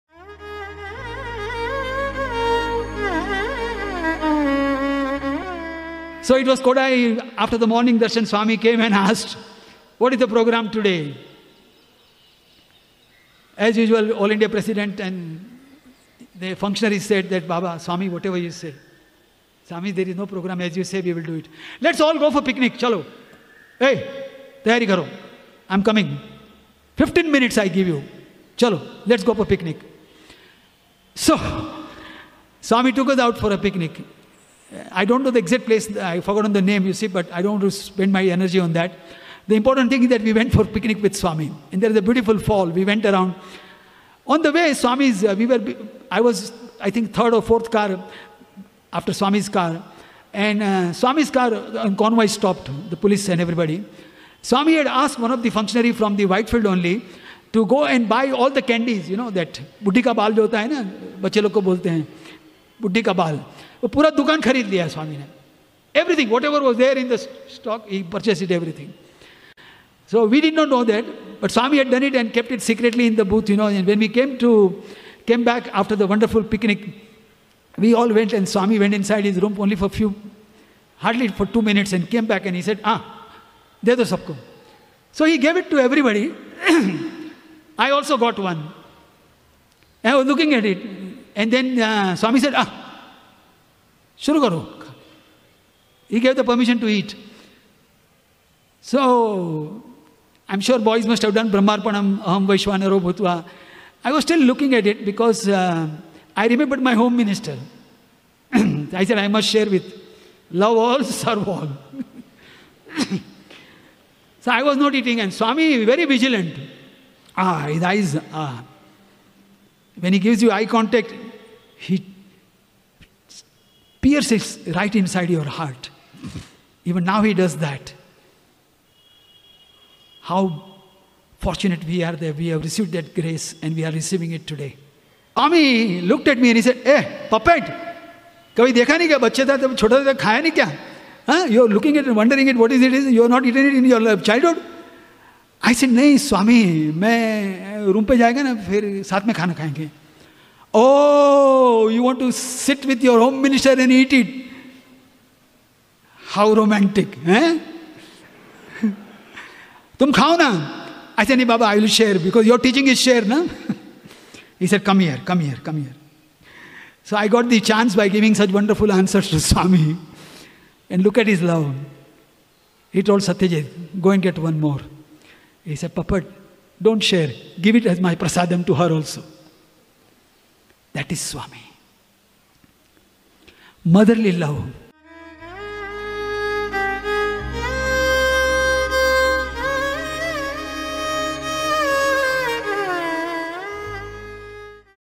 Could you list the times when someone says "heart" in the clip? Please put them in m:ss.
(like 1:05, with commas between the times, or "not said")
2:05.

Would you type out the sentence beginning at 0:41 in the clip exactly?
And there is a beautiful fall.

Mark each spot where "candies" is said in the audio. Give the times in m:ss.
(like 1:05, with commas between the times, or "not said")
0:58.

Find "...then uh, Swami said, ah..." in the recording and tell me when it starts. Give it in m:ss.
1:31.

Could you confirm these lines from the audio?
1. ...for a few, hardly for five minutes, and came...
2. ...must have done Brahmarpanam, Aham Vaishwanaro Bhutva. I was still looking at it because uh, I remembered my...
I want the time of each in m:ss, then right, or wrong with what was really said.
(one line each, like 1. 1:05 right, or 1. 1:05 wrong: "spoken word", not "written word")
1. 1:19 wrong: "two", not "five"
2. 1:41 right.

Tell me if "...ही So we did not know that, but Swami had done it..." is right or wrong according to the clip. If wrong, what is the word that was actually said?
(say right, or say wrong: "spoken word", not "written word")
right.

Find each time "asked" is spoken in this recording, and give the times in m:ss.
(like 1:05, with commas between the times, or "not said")
0:08, 0:54.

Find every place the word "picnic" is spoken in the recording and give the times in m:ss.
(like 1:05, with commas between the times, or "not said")
0:22, 0:29, 0:33, 0:40, 1:16.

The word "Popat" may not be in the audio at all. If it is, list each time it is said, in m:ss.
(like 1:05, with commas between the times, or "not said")
2:17, 2:55.